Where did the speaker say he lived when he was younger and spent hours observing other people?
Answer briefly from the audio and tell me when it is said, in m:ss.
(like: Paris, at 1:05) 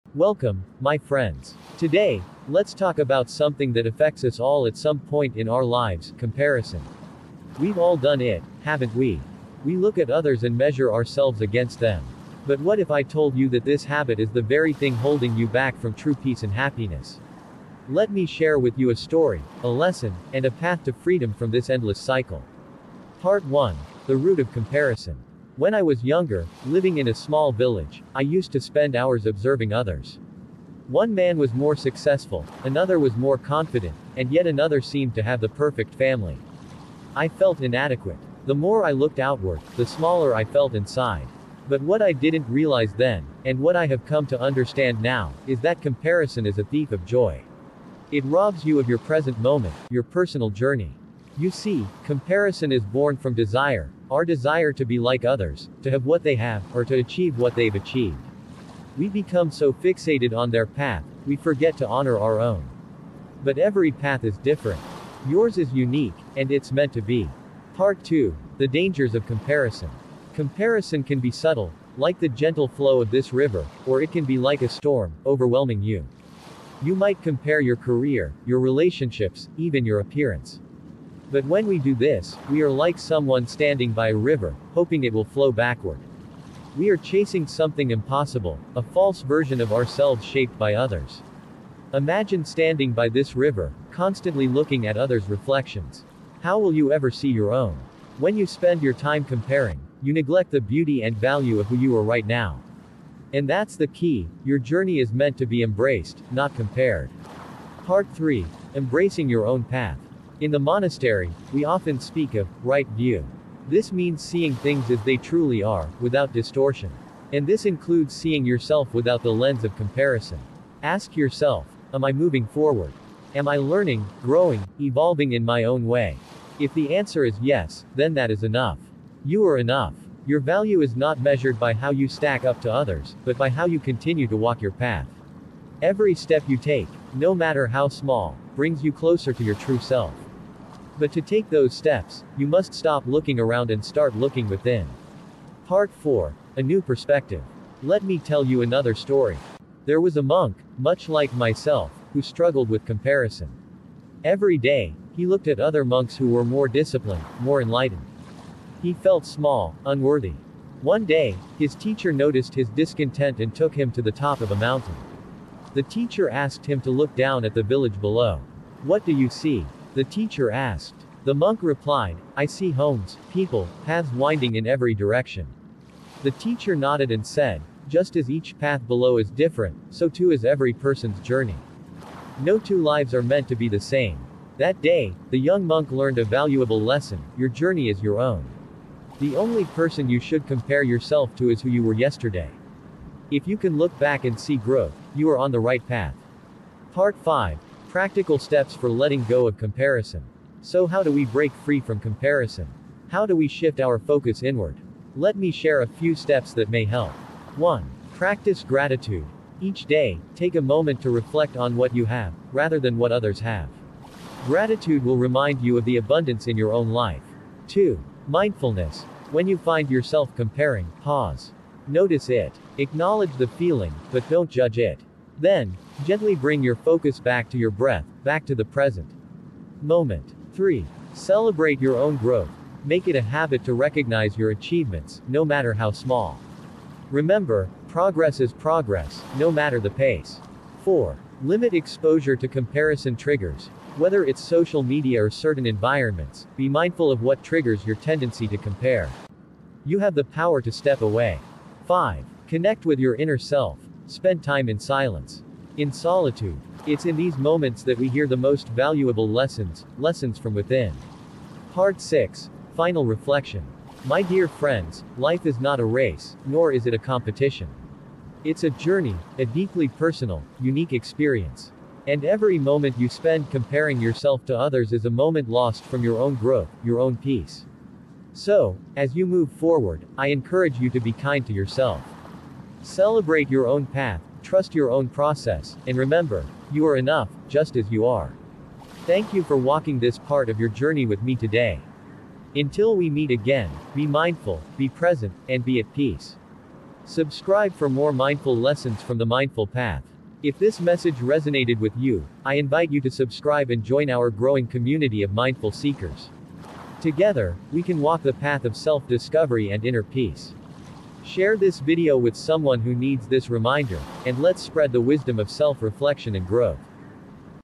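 A small village, at 0:27.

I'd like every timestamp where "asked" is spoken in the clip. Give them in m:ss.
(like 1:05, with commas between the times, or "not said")
2:46, 2:50.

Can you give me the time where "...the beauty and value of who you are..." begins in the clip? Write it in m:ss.
1:40.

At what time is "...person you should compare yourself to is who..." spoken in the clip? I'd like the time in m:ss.
3:09.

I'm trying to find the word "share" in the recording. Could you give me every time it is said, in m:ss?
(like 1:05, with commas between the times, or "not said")
0:18, 3:25, 5:11.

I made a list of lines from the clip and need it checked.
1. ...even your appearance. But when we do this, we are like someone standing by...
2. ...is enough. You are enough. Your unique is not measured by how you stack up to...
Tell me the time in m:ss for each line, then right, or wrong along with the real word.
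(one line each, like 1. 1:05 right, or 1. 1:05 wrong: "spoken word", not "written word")
1. 1:19 right
2. 2:08 wrong: "value", not "unique".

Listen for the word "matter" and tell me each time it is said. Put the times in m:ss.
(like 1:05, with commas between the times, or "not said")
2:17, 3:55, 3:59.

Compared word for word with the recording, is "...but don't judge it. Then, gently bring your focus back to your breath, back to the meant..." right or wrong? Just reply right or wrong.
wrong.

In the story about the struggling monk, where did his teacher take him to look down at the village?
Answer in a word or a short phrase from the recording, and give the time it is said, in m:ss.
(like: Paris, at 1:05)
Top of a mountain, at 2:44.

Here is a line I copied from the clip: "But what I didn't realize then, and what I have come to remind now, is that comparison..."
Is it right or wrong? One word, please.
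wrong.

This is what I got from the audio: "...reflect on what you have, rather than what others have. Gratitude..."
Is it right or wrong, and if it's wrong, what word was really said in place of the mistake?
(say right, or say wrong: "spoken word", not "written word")
right.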